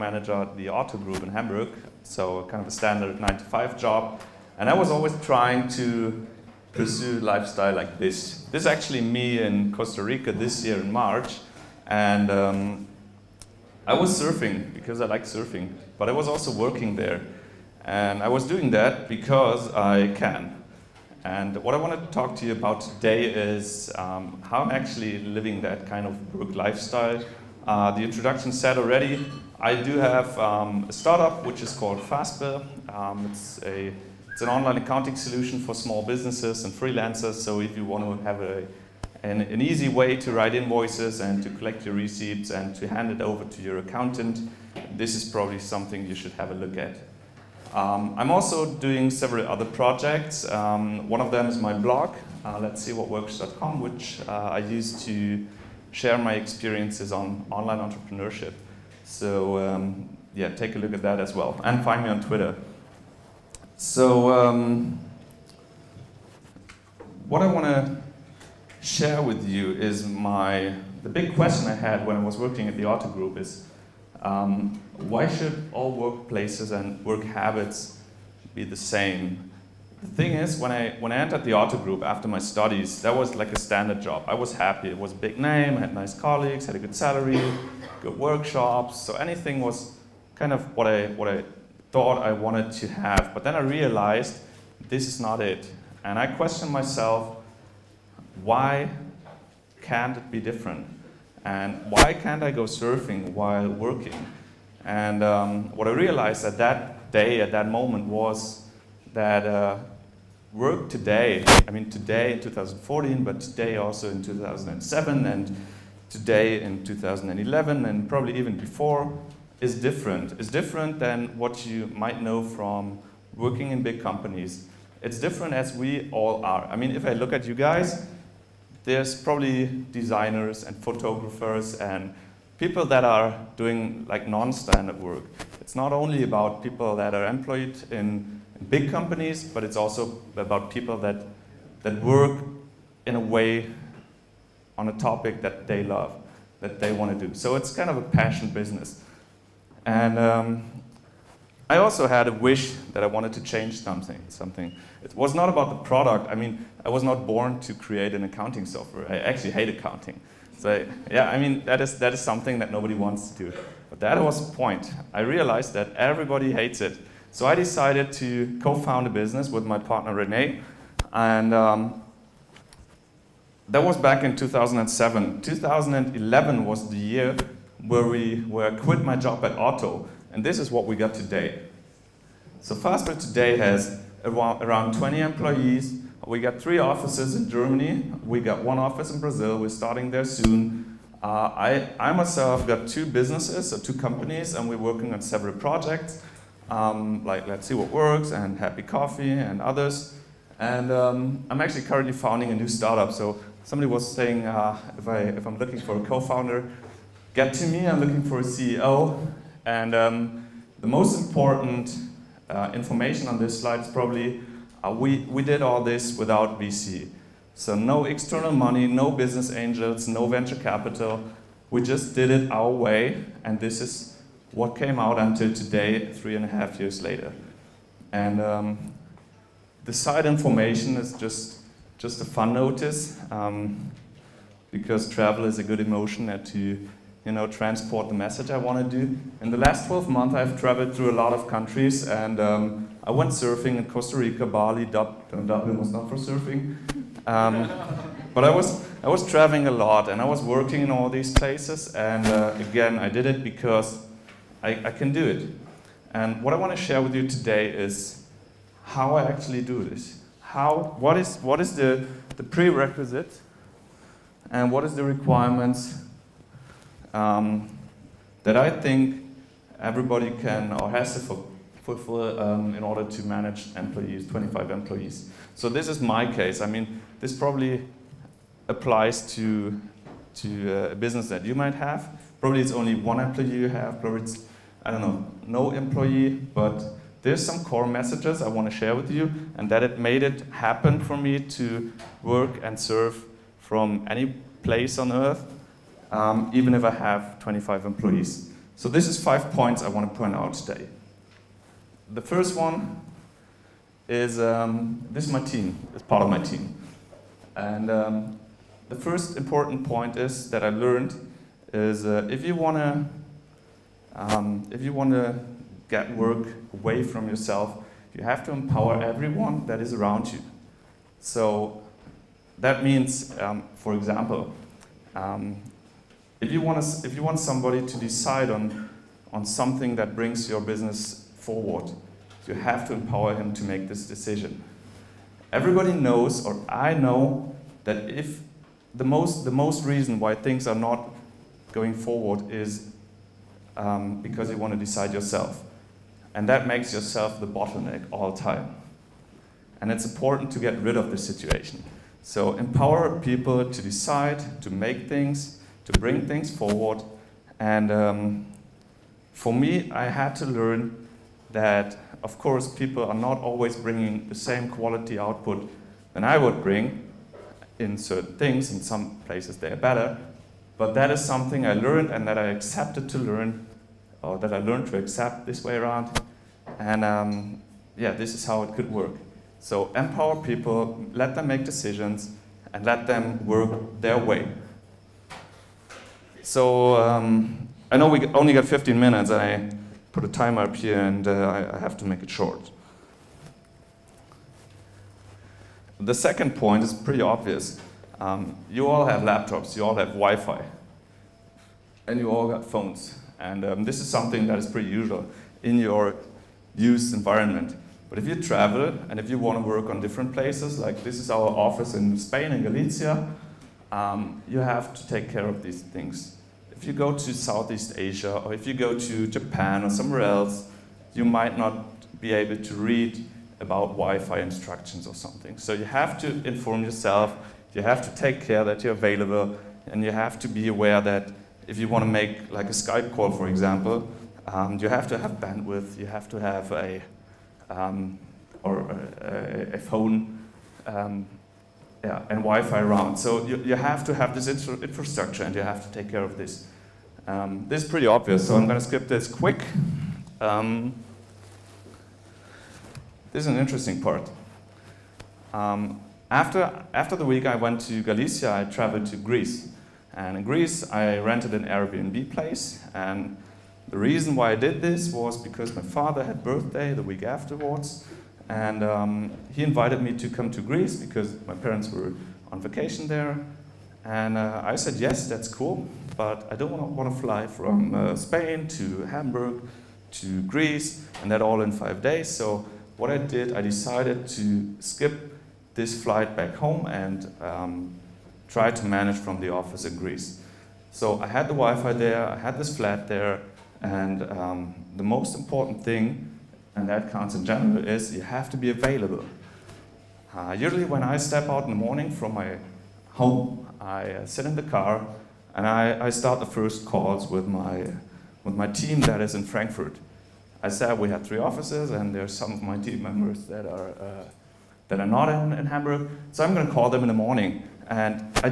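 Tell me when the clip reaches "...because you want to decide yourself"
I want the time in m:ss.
5:44.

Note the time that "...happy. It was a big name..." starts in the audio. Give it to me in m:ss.
1:24.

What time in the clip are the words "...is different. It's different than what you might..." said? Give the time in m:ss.
1:59.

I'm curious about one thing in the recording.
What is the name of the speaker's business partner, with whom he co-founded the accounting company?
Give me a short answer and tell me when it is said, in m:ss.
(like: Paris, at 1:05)
Renee, at 2:50.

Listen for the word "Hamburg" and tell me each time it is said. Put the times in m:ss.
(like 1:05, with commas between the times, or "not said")
0:01, 7:59, 8:35.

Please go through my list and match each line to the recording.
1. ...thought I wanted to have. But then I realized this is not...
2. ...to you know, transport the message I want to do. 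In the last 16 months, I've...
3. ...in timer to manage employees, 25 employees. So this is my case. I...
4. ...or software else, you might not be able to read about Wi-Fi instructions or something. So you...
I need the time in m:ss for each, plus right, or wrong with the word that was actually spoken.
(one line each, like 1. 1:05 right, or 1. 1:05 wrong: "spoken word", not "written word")
1. 1:31 right
2. 3:56 wrong: "12", not "16"
3. 4:32 wrong: "order", not "timer"
4. 6:59 wrong: "somewhere", not "software".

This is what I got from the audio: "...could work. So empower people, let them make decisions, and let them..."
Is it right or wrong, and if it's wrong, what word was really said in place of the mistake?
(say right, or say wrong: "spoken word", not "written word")
right.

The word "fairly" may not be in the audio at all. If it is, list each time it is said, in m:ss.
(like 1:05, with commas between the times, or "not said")
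not said.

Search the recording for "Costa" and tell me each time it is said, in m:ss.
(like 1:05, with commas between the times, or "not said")
0:09, 4:03.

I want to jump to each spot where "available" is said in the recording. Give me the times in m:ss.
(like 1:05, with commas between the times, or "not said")
7:08, 8:18.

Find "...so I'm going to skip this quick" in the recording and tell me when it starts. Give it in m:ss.
7:28.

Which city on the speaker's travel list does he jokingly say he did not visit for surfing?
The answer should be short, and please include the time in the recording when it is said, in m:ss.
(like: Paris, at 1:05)
Dublin, at 4:05.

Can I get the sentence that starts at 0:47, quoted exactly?
Um, I'm also doing several other projects.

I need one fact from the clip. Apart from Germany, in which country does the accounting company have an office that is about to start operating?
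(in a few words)
Brazil.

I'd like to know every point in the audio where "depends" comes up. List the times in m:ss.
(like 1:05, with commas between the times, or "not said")
not said.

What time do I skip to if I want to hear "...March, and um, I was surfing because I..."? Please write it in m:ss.
0:10.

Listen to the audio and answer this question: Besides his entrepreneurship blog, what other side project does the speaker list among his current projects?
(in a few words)
Happy Coffee.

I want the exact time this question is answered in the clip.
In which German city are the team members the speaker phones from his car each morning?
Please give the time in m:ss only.
8:29.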